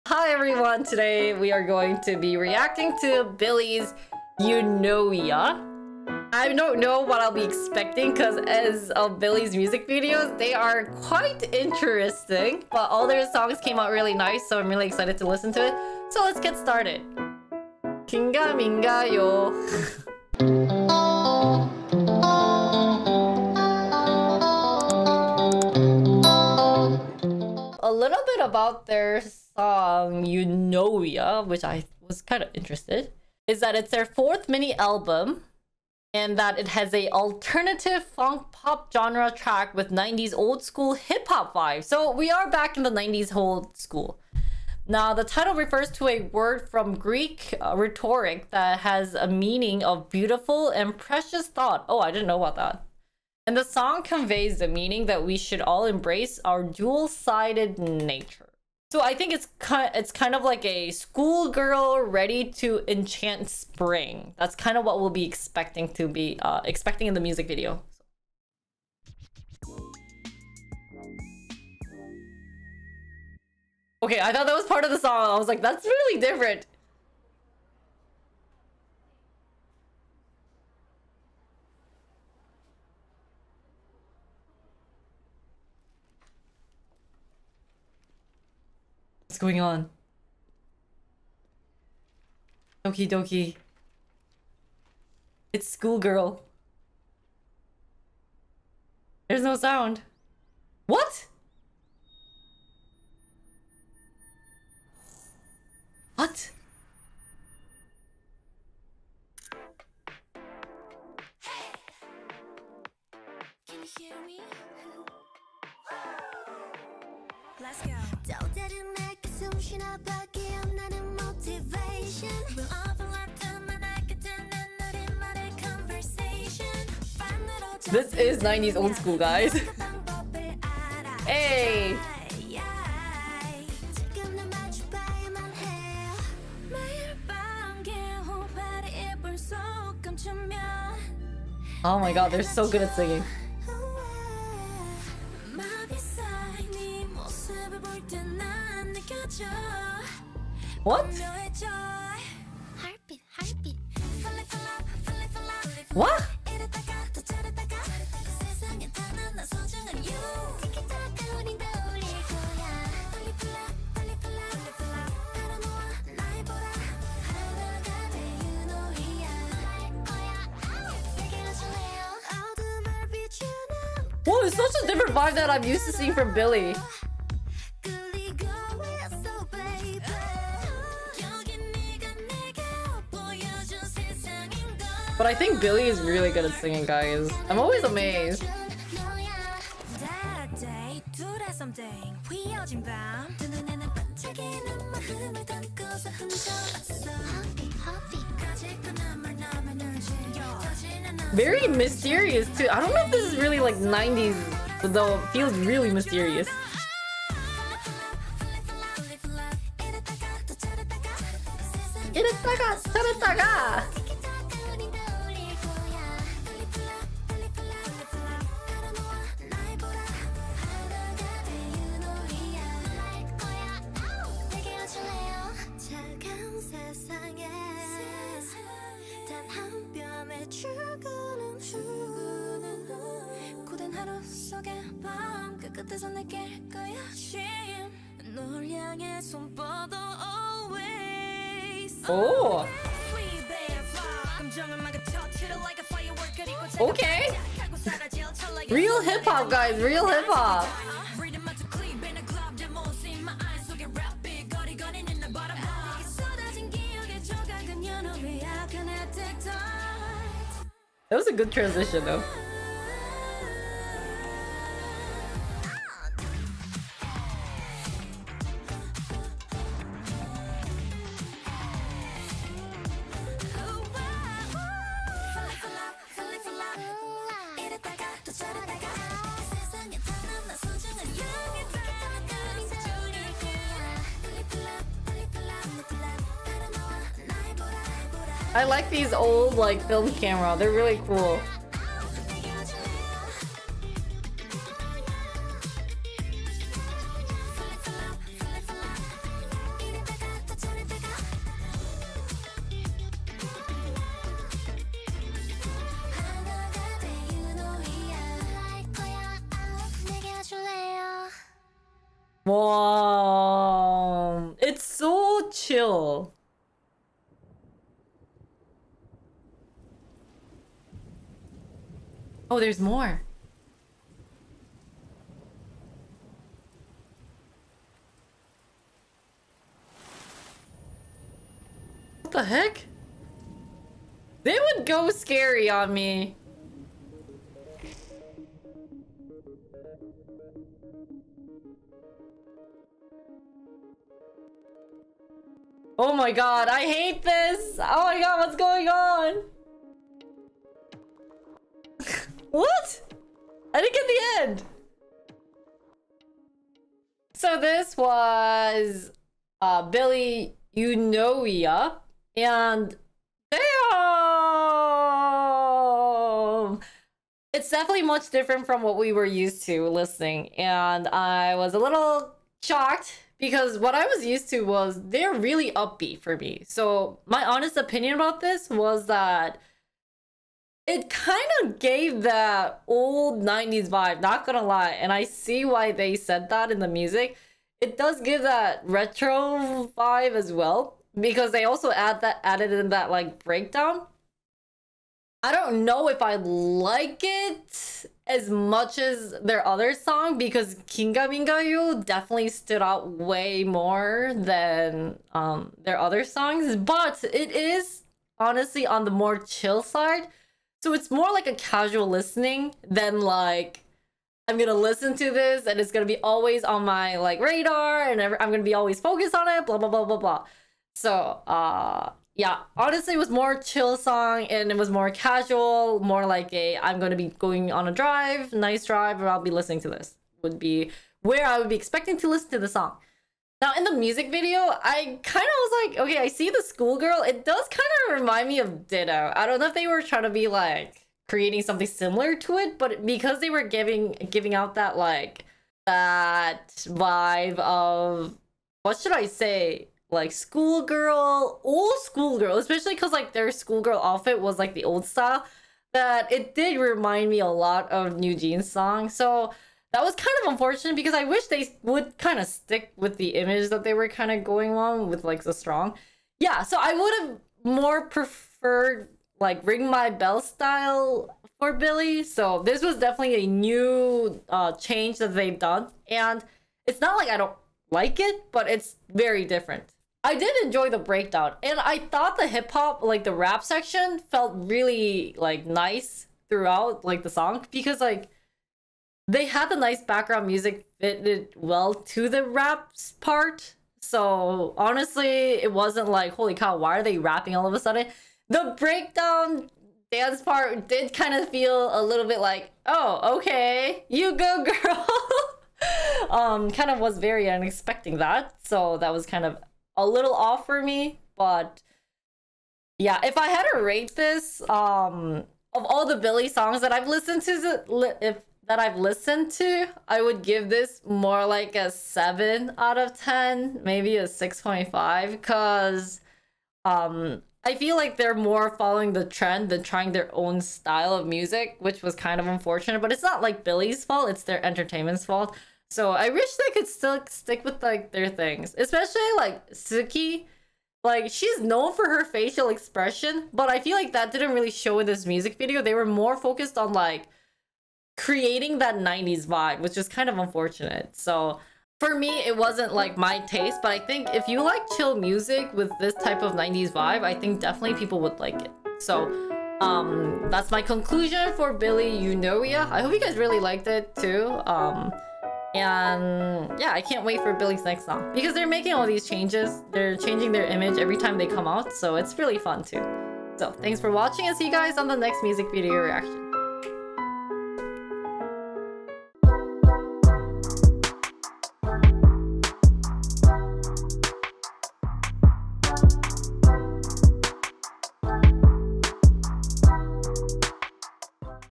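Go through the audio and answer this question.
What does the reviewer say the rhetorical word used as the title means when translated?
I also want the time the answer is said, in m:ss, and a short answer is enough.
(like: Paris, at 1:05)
beautiful and precious thought, at 0:50.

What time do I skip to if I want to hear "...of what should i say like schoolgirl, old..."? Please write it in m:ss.
7:27.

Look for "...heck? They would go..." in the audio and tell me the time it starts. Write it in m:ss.
5:32.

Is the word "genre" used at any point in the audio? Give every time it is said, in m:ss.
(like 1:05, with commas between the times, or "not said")
0:38.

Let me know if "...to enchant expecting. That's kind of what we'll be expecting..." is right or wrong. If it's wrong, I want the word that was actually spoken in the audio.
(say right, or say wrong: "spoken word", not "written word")
wrong: "spring", not "expecting".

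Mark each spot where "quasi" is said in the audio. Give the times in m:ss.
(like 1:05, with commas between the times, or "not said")
not said.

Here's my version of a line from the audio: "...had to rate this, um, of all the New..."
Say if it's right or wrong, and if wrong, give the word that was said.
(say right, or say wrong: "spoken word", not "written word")
wrong: "Billlie", not "New".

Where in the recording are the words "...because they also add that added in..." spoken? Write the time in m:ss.
6:31.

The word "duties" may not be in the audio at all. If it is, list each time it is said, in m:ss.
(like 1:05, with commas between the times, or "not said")
not said.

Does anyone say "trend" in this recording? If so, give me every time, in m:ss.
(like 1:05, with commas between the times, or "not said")
8:49.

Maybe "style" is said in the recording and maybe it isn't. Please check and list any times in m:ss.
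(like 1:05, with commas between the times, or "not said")
7:35, 7:50, 8:50.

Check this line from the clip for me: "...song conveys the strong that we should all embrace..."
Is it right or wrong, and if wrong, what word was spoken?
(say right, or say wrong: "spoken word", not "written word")
wrong: "meaning", not "strong".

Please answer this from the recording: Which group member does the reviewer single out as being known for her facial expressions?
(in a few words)
Tsuki.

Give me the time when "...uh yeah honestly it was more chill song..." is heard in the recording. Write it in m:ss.
7:01.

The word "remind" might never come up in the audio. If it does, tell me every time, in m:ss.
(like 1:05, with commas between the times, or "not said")
7:18, 7:36.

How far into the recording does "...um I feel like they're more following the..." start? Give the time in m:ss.
8:46.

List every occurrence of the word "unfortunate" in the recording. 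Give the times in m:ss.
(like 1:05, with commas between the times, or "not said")
7:40, 8:52, 9:10.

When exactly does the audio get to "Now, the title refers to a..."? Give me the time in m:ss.
0:44.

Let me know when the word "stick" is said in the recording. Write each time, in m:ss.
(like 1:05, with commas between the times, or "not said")
7:42, 8:57.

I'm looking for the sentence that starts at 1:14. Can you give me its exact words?
Okay, I thought that was part of the song.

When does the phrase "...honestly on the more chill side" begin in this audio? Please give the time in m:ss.
6:48.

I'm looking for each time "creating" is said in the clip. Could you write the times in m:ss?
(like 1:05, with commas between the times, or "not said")
7:21, 9:08.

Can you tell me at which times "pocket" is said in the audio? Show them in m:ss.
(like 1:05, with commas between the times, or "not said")
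not said.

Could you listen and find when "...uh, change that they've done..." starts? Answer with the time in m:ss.
7:54.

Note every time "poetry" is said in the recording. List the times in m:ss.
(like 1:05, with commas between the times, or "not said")
not said.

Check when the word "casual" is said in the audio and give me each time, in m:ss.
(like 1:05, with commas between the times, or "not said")
6:51, 7:05.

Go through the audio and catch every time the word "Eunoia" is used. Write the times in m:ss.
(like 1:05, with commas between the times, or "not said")
0:30, 6:00.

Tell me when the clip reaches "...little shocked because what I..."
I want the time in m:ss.
6:11.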